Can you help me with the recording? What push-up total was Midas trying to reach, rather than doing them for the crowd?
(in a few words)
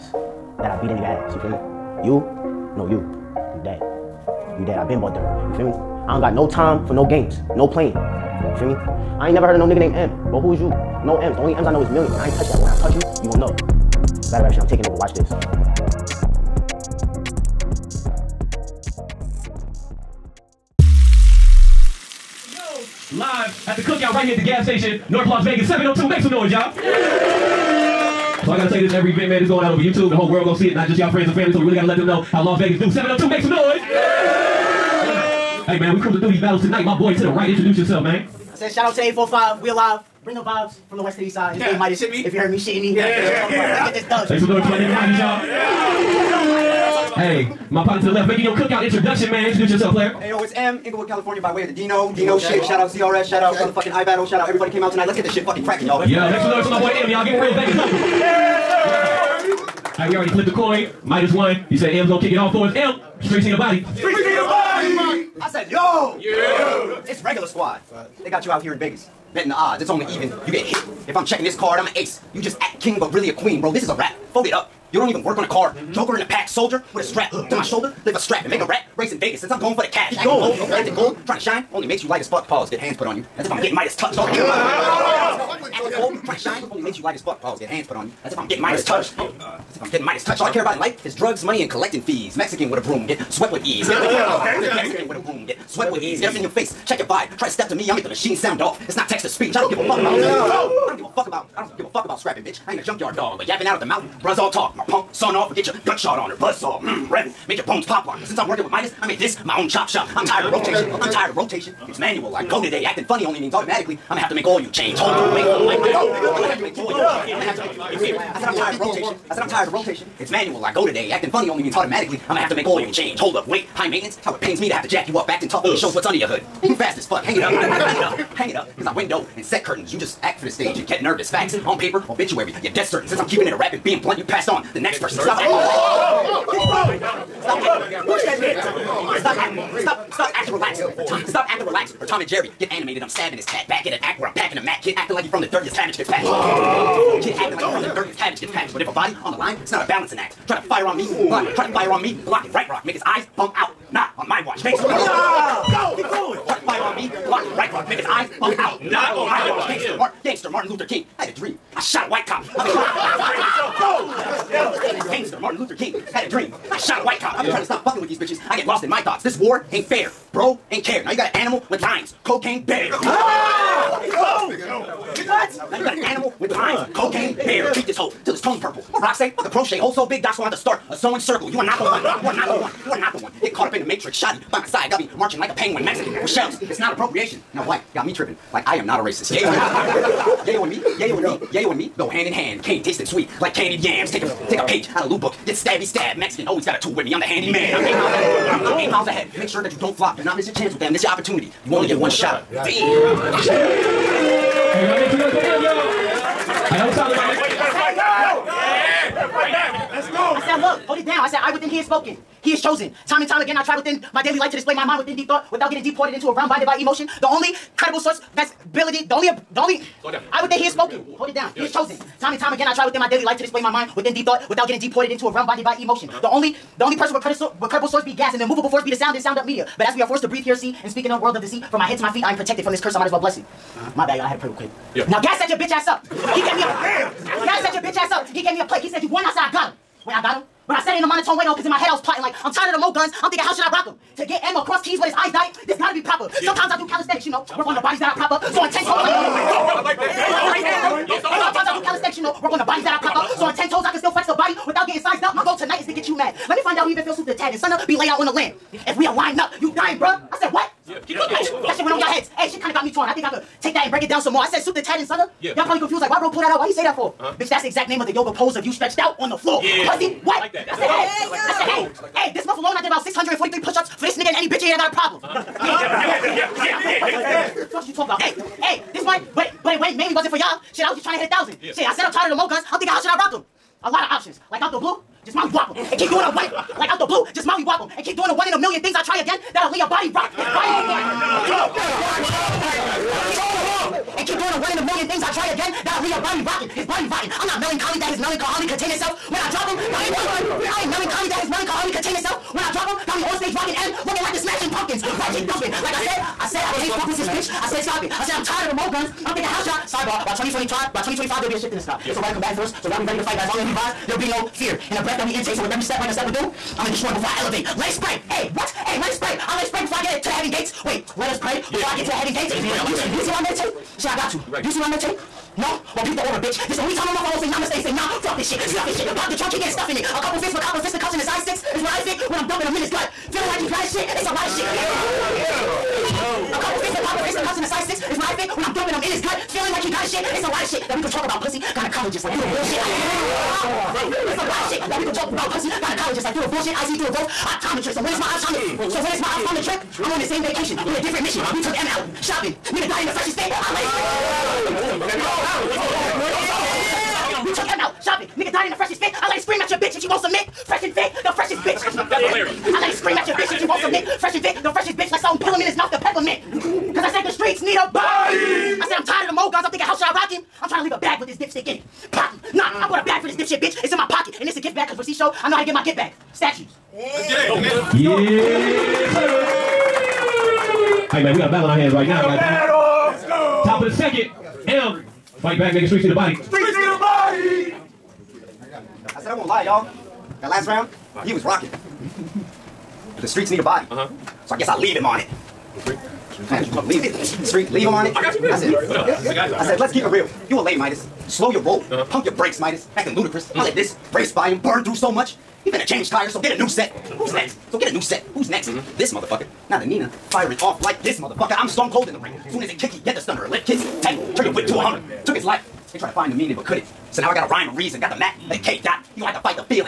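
a thousand.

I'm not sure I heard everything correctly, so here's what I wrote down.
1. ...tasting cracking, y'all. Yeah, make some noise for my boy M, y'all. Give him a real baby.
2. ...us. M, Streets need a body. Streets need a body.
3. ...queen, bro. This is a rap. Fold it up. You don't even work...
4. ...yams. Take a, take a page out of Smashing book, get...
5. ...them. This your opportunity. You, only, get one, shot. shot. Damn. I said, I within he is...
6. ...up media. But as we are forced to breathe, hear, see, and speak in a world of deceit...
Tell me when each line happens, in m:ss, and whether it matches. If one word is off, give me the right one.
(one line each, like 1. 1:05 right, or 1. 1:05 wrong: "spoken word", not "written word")
1. 0:55 wrong: "fucking", not "tasting"
2. 1:02 right
3. 1:13 right
4. 3:13 wrong: "Lou", not "Smashing"
5. 3:20 right
6. 3:49 right.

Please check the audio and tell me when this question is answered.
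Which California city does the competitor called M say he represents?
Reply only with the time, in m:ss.
0:50.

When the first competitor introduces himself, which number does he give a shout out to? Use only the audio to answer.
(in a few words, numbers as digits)
845.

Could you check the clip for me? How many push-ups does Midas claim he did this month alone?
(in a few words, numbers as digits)
643.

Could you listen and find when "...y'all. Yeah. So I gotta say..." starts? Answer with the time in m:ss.
0:26.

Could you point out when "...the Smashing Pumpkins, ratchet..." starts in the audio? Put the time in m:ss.
5:04.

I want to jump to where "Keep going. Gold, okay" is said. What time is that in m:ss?
1:20.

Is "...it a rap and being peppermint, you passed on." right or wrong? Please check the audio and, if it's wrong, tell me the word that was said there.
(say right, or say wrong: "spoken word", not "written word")
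wrong: "blunt", not "peppermint".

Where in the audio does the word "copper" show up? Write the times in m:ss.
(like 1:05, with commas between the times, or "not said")
5:30, 5:37.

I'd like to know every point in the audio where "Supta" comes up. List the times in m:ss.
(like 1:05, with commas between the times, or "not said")
4:17, 4:24.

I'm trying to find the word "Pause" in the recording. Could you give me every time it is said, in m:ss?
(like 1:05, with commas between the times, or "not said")
1:22, 1:27.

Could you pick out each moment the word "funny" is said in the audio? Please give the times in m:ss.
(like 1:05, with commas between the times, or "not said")
1:53, 2:01.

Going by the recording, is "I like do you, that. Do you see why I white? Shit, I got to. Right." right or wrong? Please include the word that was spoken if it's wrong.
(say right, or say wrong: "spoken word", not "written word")
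wrong: "meditate", not "white".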